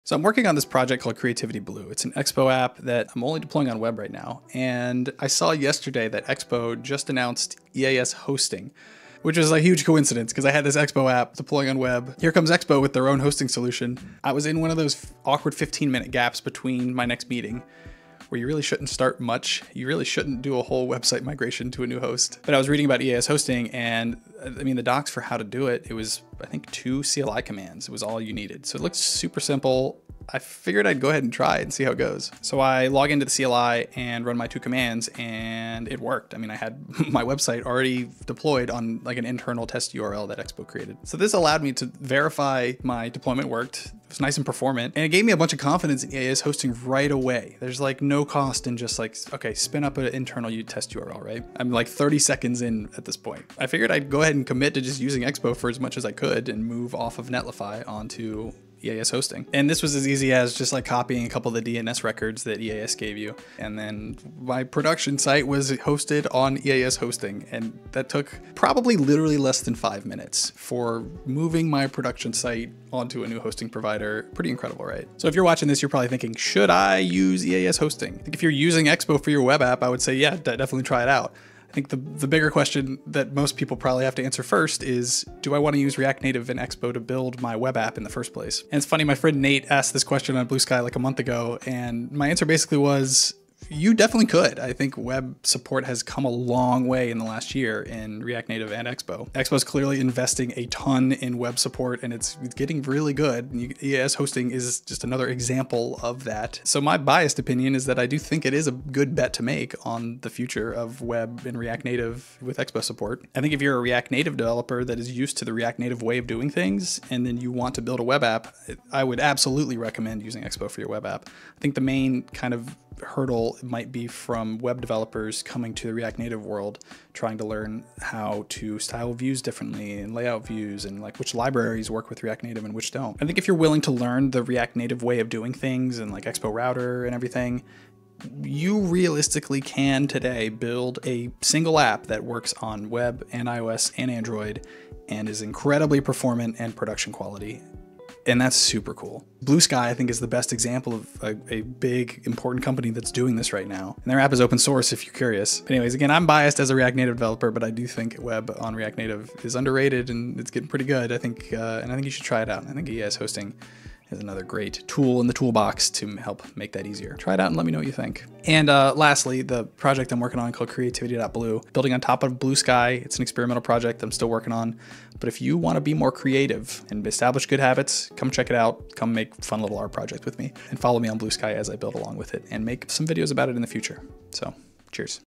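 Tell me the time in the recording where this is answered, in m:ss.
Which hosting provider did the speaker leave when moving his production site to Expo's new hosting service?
0:57.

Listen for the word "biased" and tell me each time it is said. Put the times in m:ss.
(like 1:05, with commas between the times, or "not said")
1:46, 2:36.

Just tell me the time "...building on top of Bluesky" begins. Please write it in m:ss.
2:51.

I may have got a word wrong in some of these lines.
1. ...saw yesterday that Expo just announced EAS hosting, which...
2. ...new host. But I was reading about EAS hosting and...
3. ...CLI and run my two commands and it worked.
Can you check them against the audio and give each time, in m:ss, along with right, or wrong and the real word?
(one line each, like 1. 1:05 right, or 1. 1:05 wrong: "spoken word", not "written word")
1. 0:05 right
2. 0:21 right
3. 0:33 right.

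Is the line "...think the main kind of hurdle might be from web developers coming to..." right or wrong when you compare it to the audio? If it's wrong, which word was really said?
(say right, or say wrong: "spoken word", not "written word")
right.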